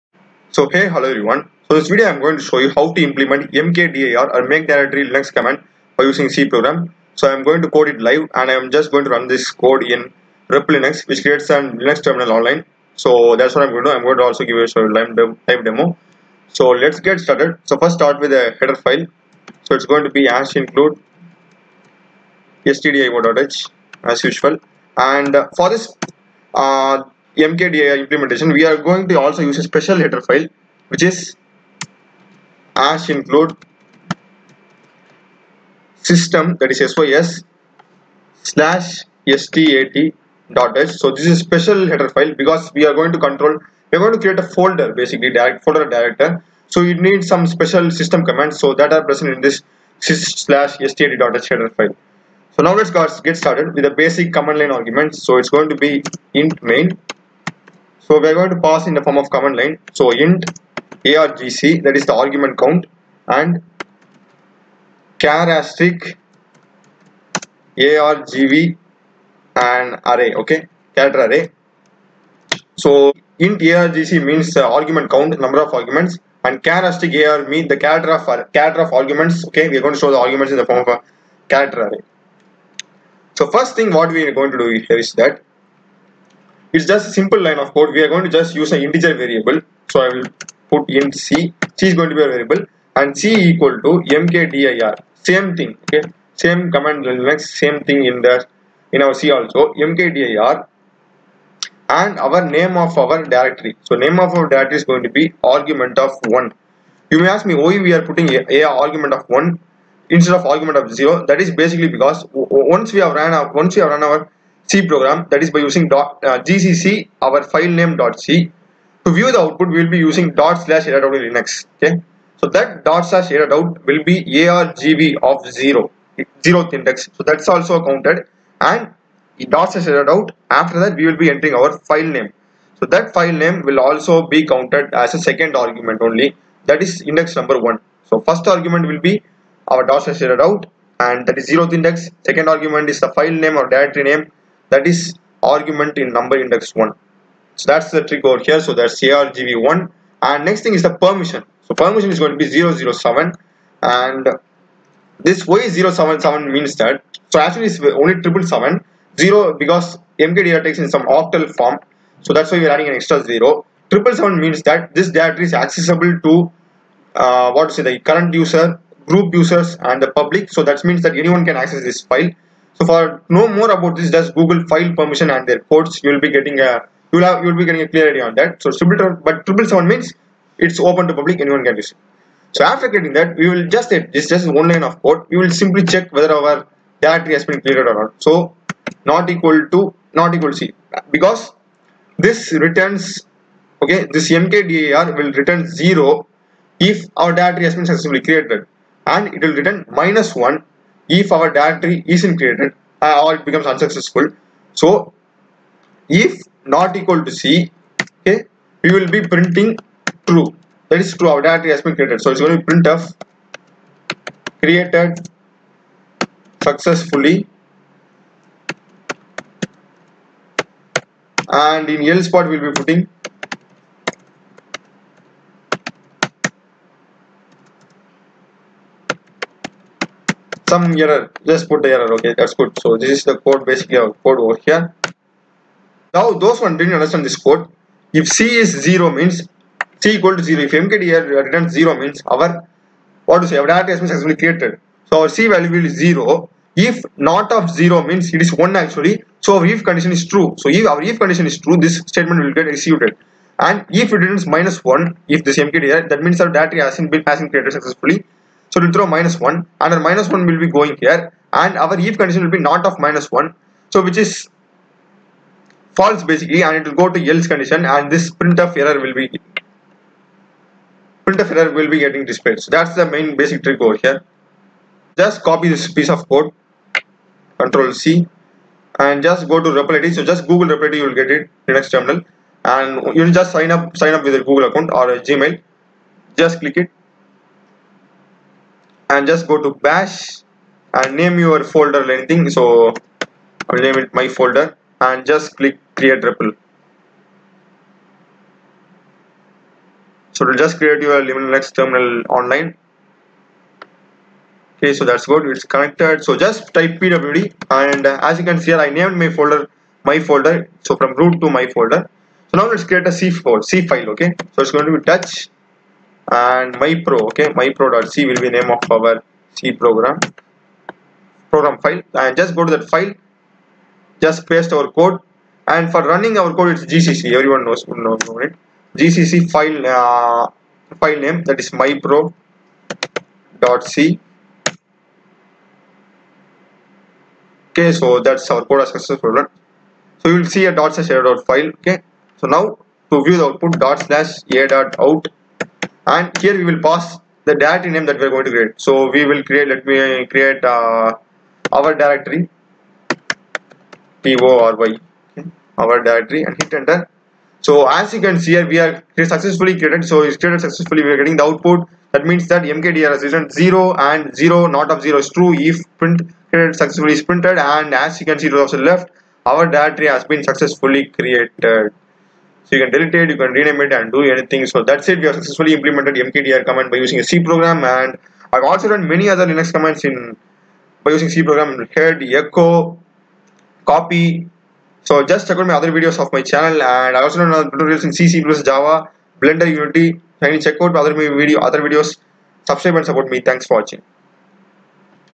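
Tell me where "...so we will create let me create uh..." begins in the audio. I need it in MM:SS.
05:48.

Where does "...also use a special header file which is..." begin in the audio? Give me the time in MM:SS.
00:29.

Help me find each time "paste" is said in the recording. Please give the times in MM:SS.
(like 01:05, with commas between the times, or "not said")
05:24.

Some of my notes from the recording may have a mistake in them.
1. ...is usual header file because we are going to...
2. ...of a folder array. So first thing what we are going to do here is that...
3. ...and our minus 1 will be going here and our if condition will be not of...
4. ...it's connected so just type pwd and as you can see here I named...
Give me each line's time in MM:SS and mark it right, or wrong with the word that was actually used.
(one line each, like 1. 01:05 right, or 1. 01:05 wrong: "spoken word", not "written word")
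1. 00:41 wrong: "special", not "usual"
2. 01:20 wrong: "character", not "folder"
3. 04:19 right
4. 05:05 right.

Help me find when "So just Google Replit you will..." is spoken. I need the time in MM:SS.
04:40.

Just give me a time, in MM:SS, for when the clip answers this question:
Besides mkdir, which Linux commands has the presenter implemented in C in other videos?
06:21.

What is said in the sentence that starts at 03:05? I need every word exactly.
We will simply check whether our directory has been cleared or not.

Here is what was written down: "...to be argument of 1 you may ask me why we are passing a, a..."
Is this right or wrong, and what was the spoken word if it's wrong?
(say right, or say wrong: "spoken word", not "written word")
wrong: "putting", not "passing".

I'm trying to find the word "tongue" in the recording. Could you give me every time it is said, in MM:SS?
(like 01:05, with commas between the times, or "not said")
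not said.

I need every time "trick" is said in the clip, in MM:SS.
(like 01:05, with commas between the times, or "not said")
02:28, 04:33.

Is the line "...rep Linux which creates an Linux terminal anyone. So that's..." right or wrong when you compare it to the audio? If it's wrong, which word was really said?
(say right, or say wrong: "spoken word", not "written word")
wrong: "online", not "anyone".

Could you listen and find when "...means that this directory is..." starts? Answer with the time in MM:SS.
02:44.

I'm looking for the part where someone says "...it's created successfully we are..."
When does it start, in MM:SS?
06:00.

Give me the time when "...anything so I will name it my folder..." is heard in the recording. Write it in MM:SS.
04:52.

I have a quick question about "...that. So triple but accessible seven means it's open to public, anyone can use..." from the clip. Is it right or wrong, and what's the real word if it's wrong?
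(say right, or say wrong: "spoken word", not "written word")
wrong: "triple", not "accessible".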